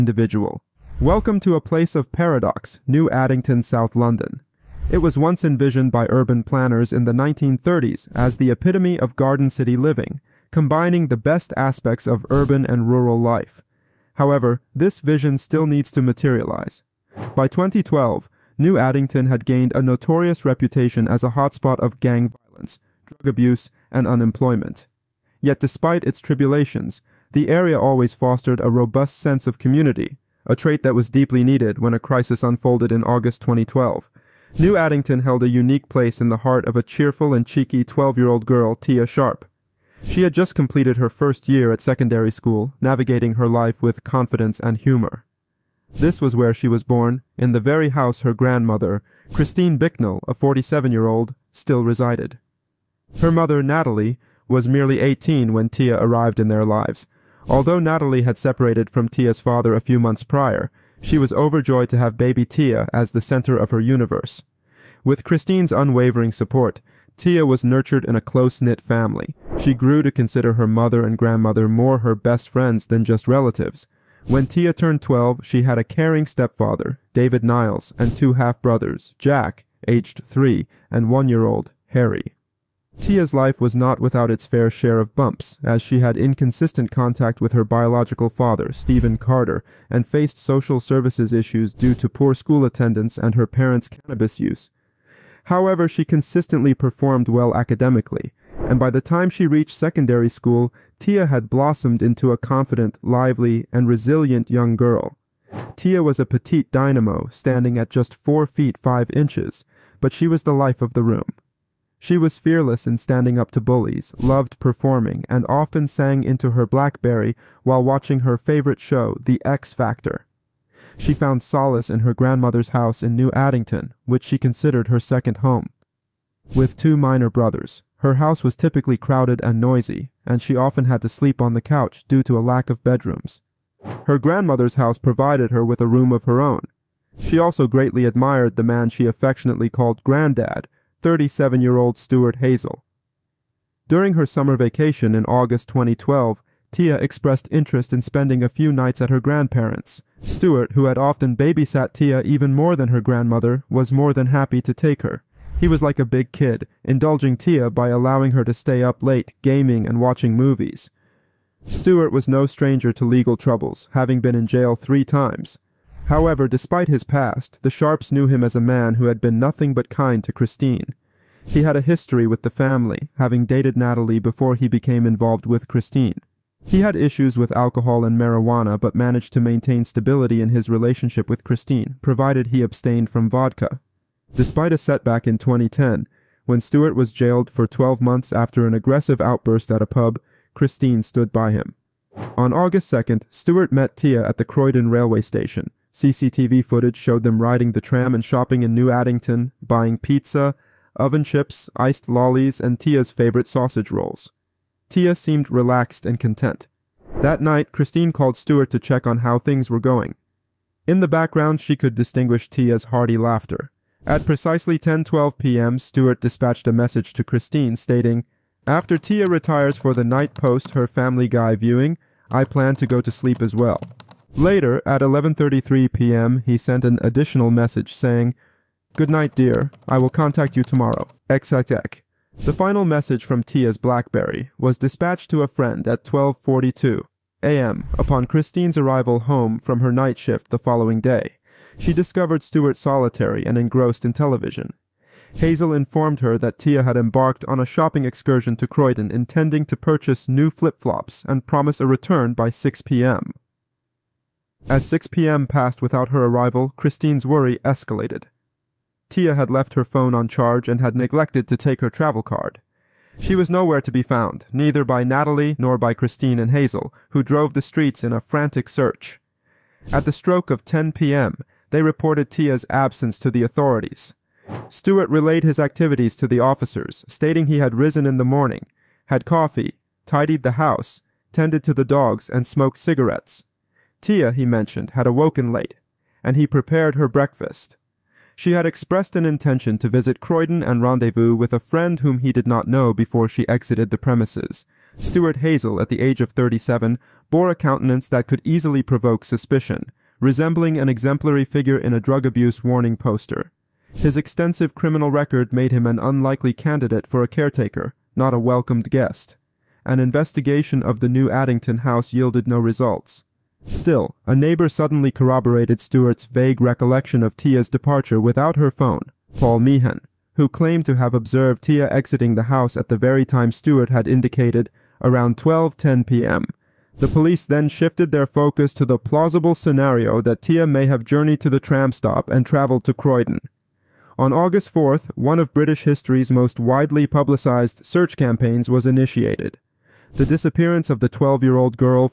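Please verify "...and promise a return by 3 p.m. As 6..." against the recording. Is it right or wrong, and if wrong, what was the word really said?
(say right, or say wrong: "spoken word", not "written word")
wrong: "6", not "3".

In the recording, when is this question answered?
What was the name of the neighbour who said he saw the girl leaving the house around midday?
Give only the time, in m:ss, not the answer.
5:19.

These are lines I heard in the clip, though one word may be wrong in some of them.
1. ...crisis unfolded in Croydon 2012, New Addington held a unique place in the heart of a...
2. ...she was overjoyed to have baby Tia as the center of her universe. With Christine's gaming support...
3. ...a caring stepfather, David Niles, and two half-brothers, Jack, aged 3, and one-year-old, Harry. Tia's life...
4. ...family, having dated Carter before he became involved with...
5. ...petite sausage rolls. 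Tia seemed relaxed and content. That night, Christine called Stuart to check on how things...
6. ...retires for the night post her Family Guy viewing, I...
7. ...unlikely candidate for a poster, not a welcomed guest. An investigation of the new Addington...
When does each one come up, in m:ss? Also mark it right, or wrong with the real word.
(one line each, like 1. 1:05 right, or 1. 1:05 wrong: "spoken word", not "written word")
1. 0:31 wrong: "August", not "Croydon"
2. 1:01 wrong: "unwavering", not "gaming"
3. 1:15 right
4. 2:52 wrong: "Natalie", not "Carter"
5. 3:23 wrong: "favorite", not "petite"
6. 3:39 right
7. 5:05 wrong: "caretaker", not "poster".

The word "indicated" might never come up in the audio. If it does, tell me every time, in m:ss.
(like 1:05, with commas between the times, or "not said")
5:24.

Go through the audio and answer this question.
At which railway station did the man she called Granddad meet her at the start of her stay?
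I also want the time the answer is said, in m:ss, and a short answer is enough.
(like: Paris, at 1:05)
Croydon railway station, at 3:14.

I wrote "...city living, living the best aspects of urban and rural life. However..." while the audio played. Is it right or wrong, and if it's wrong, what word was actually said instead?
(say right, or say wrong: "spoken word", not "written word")
wrong: "combining", not "living".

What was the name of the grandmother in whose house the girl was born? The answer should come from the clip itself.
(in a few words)
Christine Bicknell.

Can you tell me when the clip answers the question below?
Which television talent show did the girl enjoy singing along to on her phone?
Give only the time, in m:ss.
1:59.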